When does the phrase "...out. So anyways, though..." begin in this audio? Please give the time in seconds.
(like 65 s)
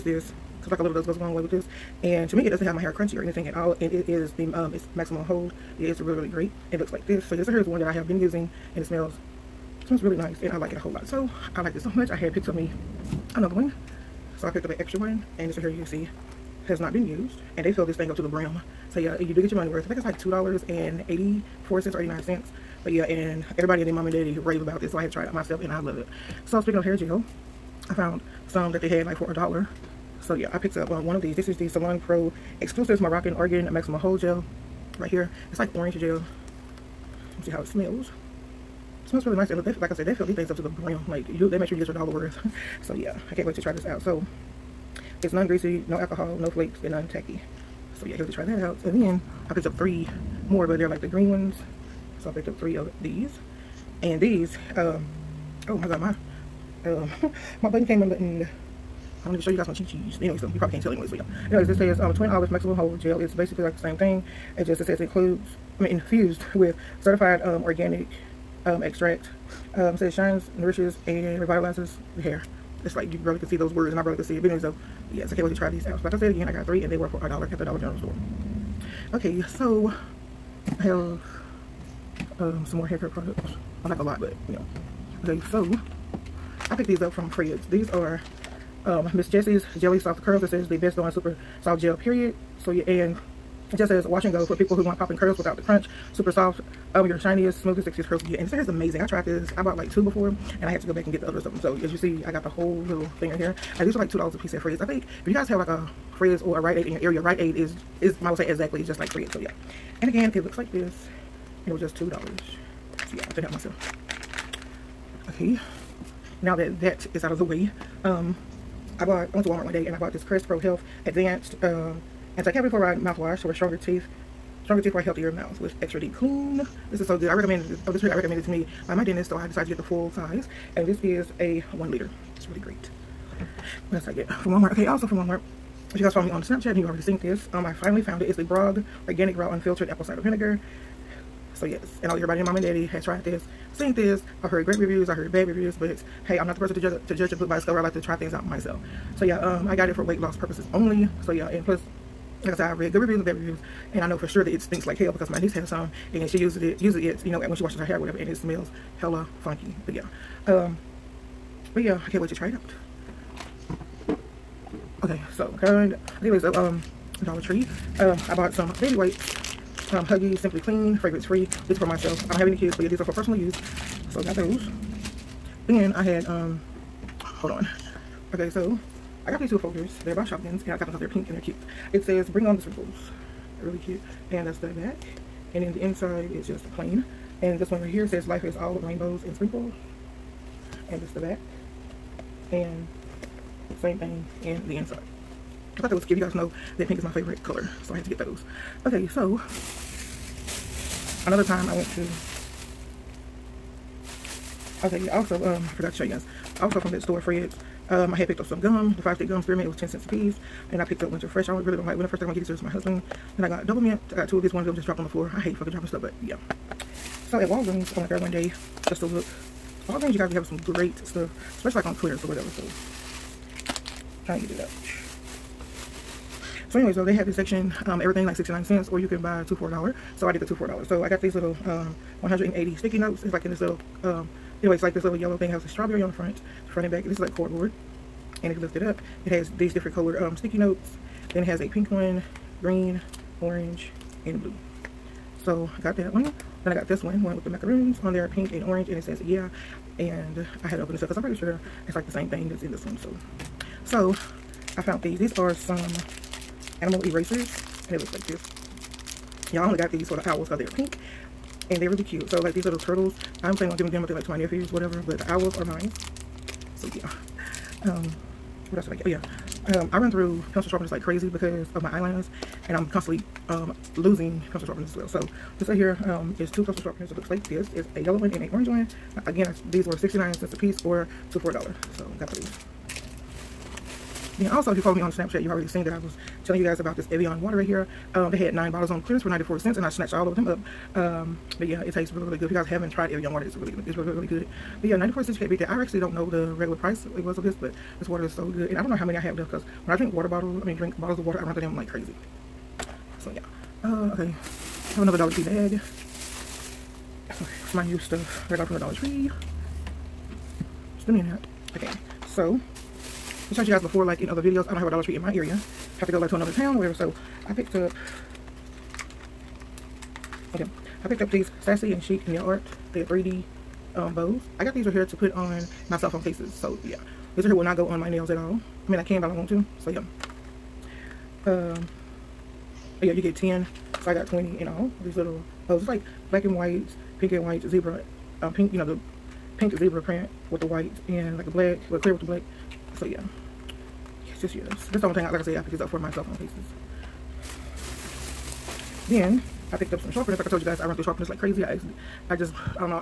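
224 s.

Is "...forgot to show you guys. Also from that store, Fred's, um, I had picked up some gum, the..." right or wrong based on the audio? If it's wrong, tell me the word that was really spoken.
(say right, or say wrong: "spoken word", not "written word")
right.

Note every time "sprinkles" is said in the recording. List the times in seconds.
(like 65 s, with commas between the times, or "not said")
182 s, 189 s.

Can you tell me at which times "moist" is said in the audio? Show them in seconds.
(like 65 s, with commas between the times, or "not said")
not said.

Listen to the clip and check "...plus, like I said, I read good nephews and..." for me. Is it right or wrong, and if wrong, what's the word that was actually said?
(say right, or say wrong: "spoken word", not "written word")
wrong: "reviews", not "nephews".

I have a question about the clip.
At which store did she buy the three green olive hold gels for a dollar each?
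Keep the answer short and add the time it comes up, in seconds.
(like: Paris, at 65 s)
Dollar General, at 77 s.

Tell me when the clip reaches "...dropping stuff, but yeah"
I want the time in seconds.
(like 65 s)
215 s.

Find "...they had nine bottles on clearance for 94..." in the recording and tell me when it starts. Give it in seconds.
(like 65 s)
288 s.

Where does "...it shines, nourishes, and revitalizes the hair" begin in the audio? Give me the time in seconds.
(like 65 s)
70 s.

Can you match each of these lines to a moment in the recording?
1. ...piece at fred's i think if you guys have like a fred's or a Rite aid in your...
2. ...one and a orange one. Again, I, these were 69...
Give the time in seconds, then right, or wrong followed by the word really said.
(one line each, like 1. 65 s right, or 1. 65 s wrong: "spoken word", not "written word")
1. 104 s right
2. 278 s right.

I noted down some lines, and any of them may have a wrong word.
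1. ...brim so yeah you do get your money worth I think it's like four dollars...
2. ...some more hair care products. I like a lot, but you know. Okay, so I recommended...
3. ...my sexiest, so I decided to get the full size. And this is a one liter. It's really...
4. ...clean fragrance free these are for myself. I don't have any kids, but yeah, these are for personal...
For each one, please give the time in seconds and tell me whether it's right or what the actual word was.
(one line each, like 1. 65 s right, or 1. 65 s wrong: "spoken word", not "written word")
1. 18 s wrong: "two", not "four"
2. 82 s wrong: "picked", not "recommended"
3. 128 s wrong: "dentist", not "sexiest"
4. 170 s right.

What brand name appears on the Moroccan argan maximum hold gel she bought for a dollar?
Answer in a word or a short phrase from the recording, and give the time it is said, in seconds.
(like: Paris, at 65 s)
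Salon Pro Exclusives, at 31 s.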